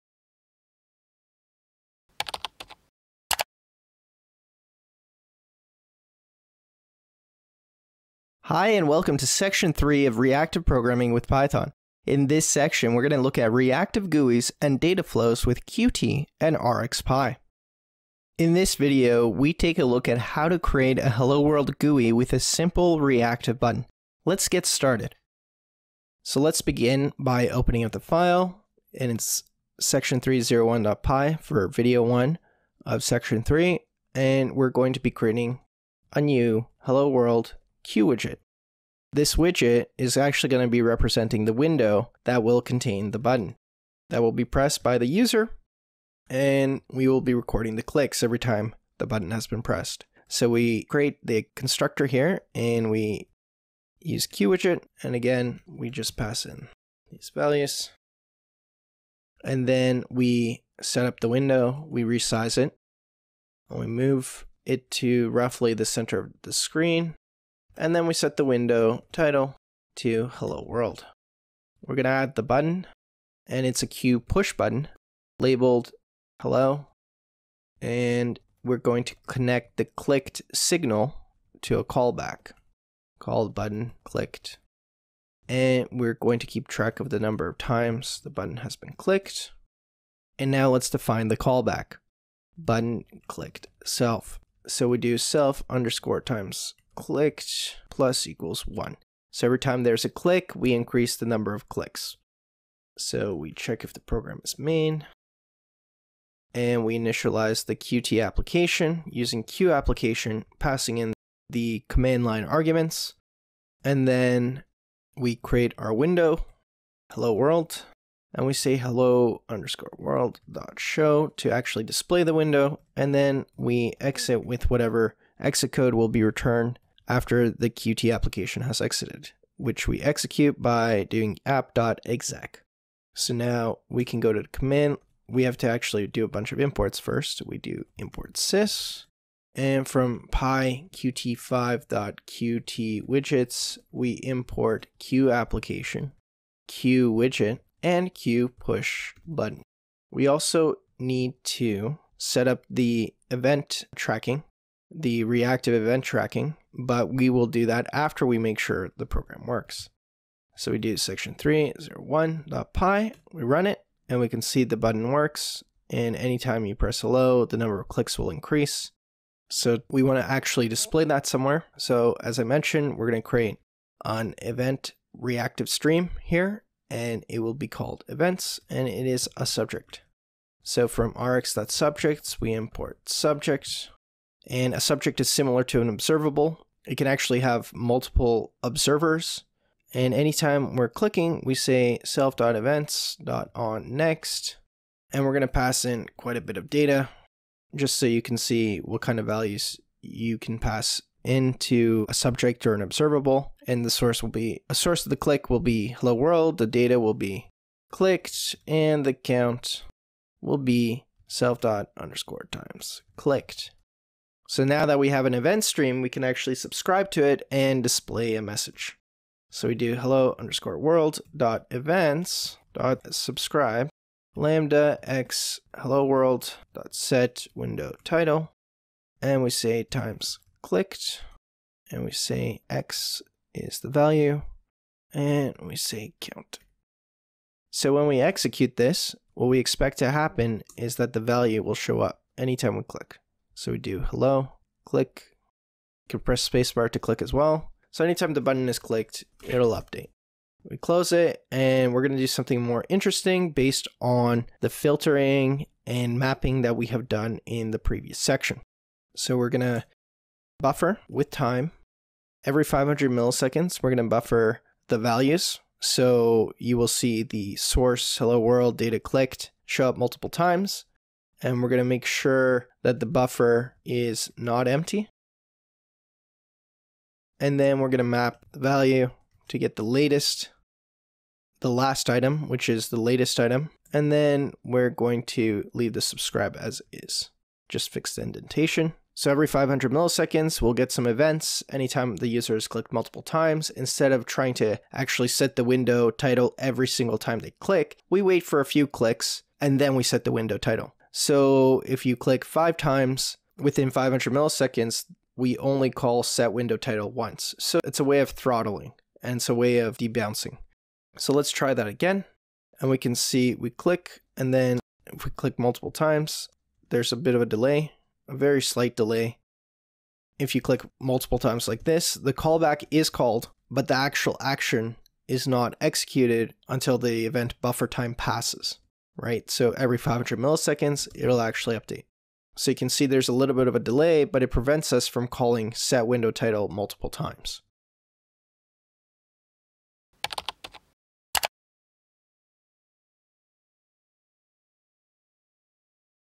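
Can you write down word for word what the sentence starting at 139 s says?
And from pyqt5.qtwidgets, we import q application, q widget, and q push button.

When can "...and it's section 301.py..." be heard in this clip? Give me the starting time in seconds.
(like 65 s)
28 s.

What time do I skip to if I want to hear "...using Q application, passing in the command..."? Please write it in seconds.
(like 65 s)
109 s.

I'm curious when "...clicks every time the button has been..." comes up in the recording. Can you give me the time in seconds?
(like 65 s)
47 s.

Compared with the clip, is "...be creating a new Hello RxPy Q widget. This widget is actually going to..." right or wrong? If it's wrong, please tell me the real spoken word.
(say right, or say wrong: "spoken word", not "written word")
wrong: "World", not "RxPy".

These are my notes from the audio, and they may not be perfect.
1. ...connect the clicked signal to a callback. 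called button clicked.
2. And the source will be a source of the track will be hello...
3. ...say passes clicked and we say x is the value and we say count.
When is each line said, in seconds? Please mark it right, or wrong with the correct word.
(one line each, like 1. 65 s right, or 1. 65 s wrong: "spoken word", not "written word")
1. 79 s right
2. 203 s wrong: "click", not "track"
3. 229 s wrong: "times", not "passes".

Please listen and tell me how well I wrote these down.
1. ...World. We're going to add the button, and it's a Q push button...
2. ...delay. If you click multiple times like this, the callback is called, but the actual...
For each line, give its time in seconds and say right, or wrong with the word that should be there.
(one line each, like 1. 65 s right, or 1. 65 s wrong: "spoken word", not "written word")
1. 70 s right
2. 318 s right.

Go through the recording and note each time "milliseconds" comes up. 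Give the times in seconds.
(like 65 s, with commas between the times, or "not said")
263 s, 289 s, 304 s, 330 s.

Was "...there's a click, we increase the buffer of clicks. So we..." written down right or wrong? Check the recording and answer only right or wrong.
wrong.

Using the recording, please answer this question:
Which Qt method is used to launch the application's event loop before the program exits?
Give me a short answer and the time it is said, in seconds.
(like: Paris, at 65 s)
app.exec, at 131 s.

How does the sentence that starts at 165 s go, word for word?
And anytime you press hello, the number of clicks will increase.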